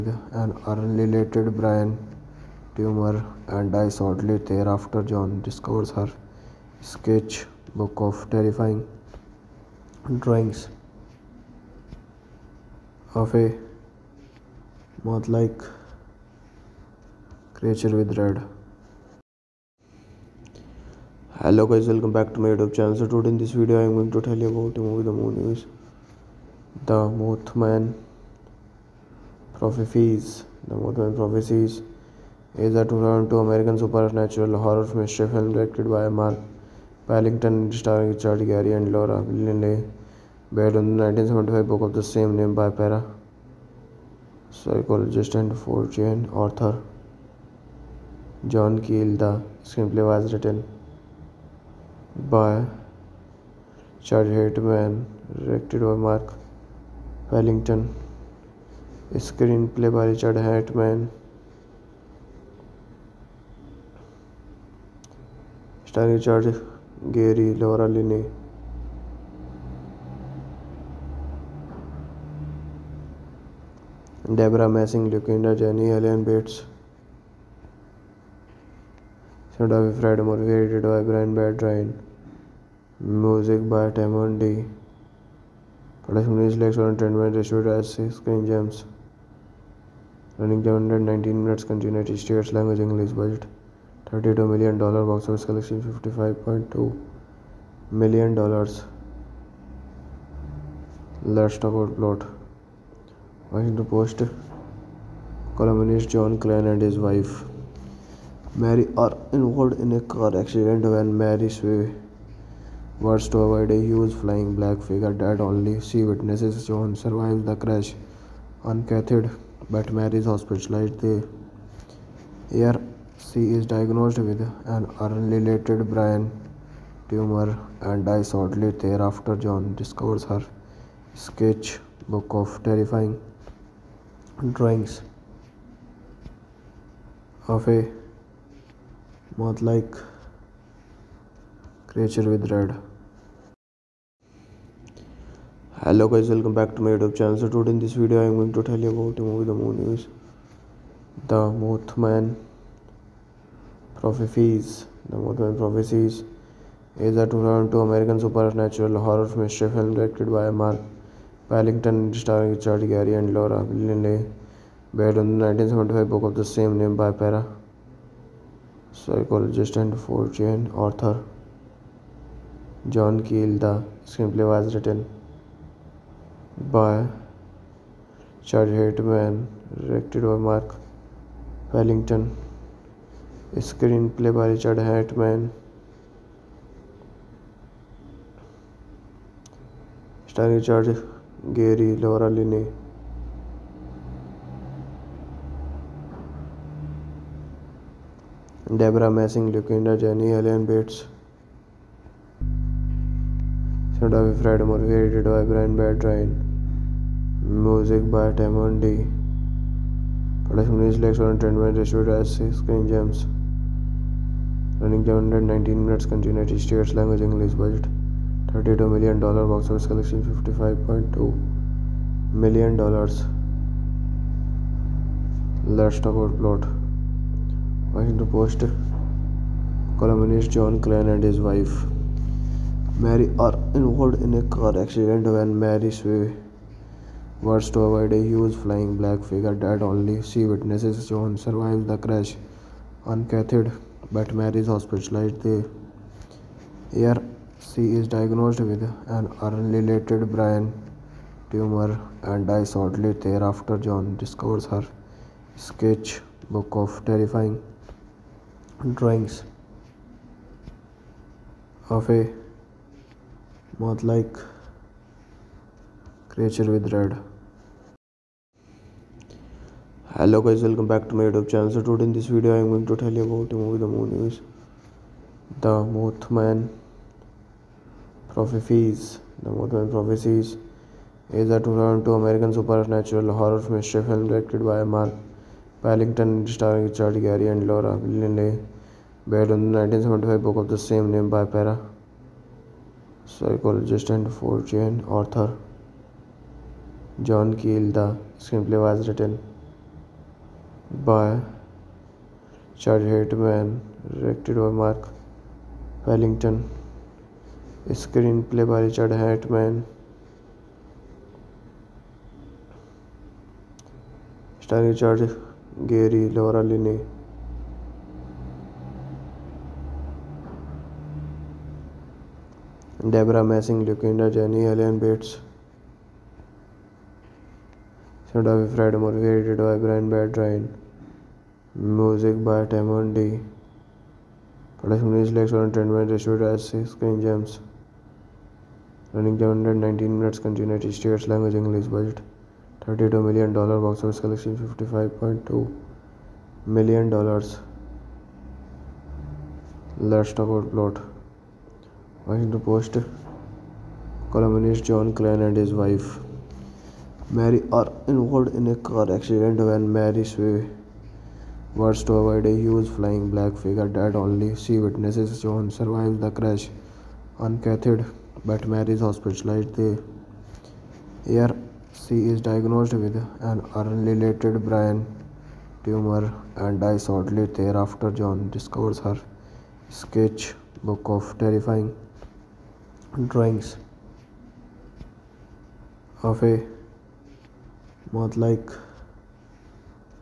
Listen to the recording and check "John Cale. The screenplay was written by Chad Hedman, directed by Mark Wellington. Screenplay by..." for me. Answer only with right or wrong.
right.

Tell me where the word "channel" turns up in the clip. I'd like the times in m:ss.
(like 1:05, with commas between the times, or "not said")
0:22, 2:27, 4:31.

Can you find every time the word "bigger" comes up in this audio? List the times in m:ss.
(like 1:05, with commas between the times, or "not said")
not said.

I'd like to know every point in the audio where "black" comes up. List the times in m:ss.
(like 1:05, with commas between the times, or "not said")
1:54, 3:58, 6:03.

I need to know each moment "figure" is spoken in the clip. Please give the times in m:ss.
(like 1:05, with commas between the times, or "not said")
1:54, 3:59, 6:03.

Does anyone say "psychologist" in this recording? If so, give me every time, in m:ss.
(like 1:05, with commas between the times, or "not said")
0:44, 2:48, 4:53.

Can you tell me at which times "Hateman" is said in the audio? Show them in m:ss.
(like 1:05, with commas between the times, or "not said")
5:03, 5:09.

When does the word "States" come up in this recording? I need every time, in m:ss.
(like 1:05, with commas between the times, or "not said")
1:32, 3:36, 5:40.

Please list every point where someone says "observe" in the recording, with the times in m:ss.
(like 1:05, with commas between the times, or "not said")
not said.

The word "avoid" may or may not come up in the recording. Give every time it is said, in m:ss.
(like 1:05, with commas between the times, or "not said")
1:53, 3:57, 6:02.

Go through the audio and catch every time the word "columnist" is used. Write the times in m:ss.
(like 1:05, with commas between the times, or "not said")
1:45, 3:49, 5:54.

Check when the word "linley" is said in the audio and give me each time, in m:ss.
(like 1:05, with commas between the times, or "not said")
0:39, 2:43, 4:47.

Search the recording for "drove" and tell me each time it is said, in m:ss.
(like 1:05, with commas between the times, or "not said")
not said.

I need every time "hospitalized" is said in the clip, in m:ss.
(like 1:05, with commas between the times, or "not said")
2:00, 4:04, 6:09.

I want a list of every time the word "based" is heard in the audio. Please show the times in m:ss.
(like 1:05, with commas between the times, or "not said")
0:40, 2:44, 4:49.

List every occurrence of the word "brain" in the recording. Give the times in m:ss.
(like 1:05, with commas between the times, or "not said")
0:01, 2:05, 4:10, 6:14.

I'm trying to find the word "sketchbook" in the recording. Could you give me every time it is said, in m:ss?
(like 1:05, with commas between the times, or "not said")
0:06, 2:11, 4:15, 6:19.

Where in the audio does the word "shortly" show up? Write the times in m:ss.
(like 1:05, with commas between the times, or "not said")
0:03, 2:08, 4:12, 6:17.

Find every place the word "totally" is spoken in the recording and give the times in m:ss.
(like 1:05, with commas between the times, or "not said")
not said.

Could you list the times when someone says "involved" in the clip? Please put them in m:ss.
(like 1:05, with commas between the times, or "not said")
1:49, 3:53, 5:58.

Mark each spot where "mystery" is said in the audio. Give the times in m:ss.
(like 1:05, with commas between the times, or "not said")
0:34, 2:39, 4:43.